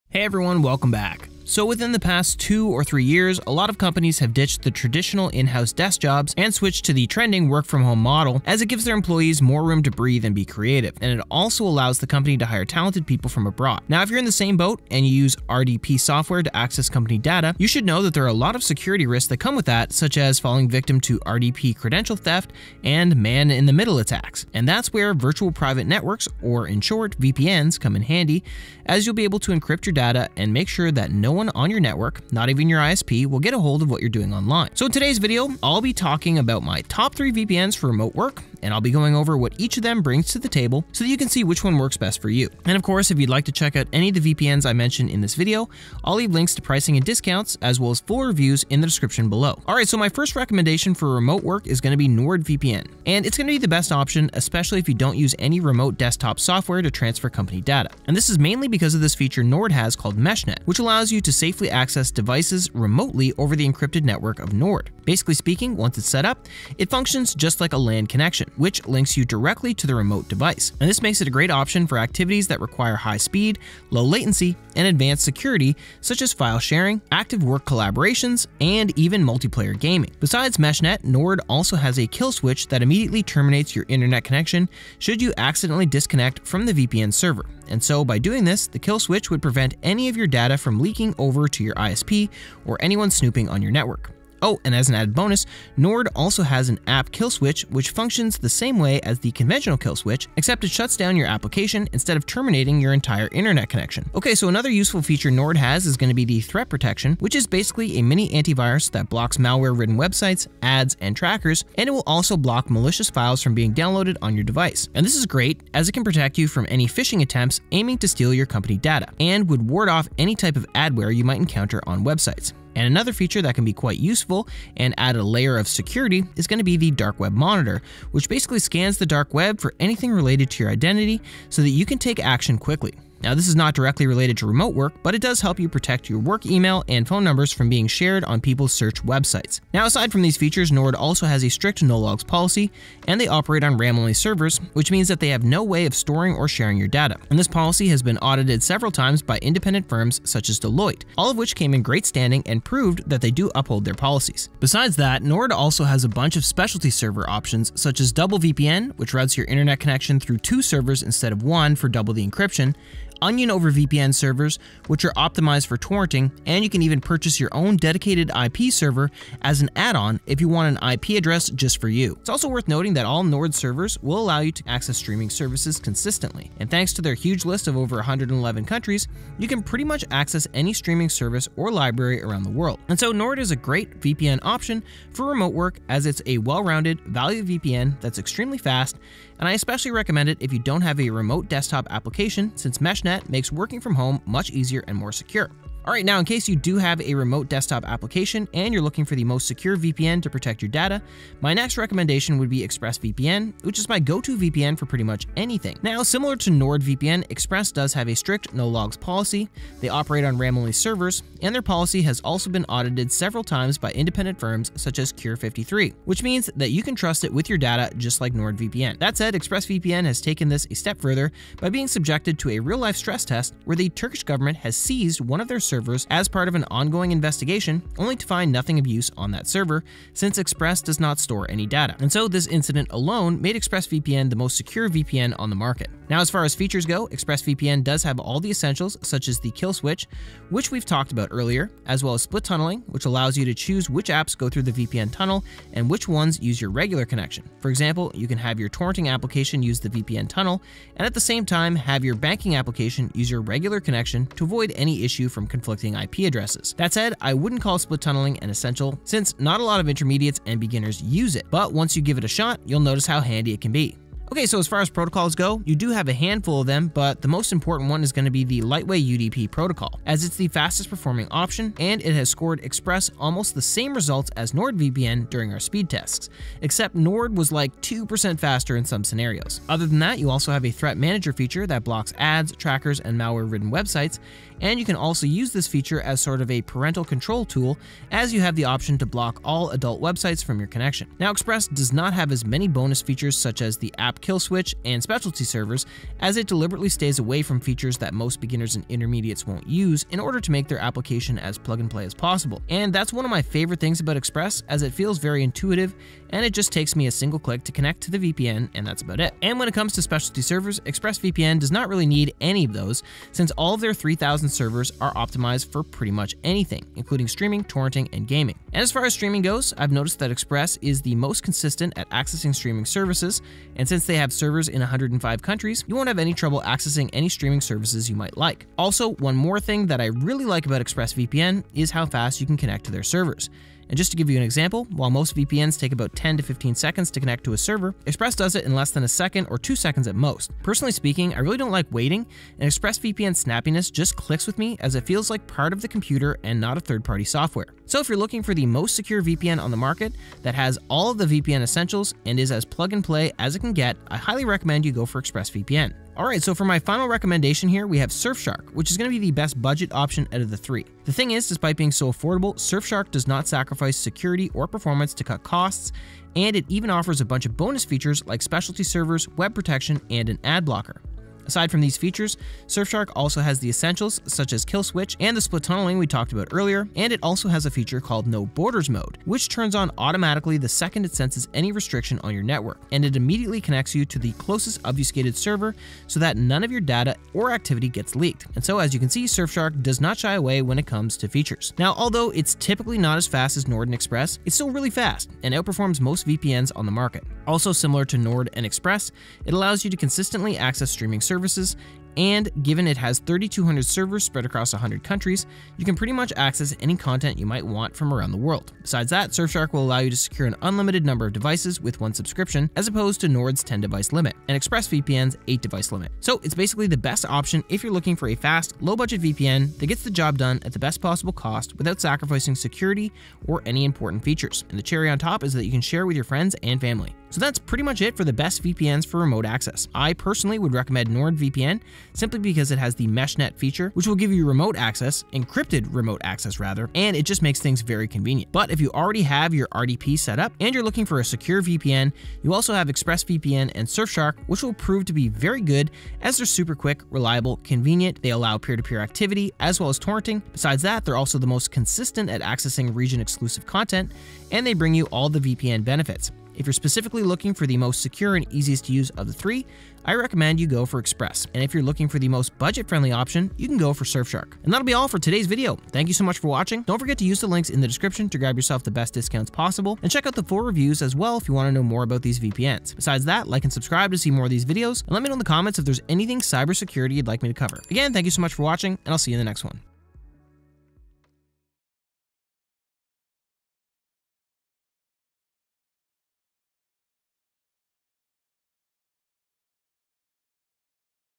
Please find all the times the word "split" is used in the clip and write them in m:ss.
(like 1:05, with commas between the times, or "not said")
4:02, 4:17, 6:15.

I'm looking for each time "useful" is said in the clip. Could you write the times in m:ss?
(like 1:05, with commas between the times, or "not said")
1:44, 2:03.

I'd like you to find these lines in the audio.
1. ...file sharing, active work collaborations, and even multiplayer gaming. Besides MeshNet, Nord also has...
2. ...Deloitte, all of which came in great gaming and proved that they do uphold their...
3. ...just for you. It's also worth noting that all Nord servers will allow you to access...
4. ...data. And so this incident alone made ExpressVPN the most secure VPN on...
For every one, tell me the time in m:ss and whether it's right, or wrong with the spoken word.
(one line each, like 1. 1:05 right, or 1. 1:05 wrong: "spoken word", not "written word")
1. 1:16 right
2. 2:30 wrong: "standing", not "gaming"
3. 2:51 right
4. 3:51 right.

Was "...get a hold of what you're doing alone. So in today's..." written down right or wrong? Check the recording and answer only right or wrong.
wrong.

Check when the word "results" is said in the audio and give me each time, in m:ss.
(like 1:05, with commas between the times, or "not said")
4:33.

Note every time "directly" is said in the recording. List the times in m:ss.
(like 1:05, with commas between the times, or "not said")
1:09, 2:13.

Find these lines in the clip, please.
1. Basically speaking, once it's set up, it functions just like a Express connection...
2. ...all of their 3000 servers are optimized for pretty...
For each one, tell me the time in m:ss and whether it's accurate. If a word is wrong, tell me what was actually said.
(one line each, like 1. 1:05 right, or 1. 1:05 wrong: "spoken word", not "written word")
1. 1:05 wrong: "LAN", not "Express"
2. 5:13 right.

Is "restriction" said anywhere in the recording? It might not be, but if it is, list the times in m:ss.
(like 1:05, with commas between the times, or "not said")
6:21.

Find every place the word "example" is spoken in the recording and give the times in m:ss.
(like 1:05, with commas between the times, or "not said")
4:07, 5:34.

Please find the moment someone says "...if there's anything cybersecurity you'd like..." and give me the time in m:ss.
7:55.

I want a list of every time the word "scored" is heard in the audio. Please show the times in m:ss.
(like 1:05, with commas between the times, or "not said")
4:32.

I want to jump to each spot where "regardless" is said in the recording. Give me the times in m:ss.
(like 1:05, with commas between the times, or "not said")
not said.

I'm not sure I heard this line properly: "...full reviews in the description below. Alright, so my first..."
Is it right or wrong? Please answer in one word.
right.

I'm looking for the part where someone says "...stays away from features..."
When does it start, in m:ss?
4:56.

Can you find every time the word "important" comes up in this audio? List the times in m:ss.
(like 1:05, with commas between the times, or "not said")
4:27, 7:03.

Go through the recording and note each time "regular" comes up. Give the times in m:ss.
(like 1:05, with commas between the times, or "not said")
4:06, 4:13.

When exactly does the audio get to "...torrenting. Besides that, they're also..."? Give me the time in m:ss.
7:29.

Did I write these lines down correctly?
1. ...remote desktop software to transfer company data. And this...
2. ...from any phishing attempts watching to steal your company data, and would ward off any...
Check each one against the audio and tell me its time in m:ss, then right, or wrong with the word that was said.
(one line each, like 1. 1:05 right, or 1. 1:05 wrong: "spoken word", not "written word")
1. 0:55 right
2. 1:56 wrong: "aiming", not "watching".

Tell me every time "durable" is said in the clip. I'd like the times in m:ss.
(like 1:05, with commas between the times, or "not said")
not said.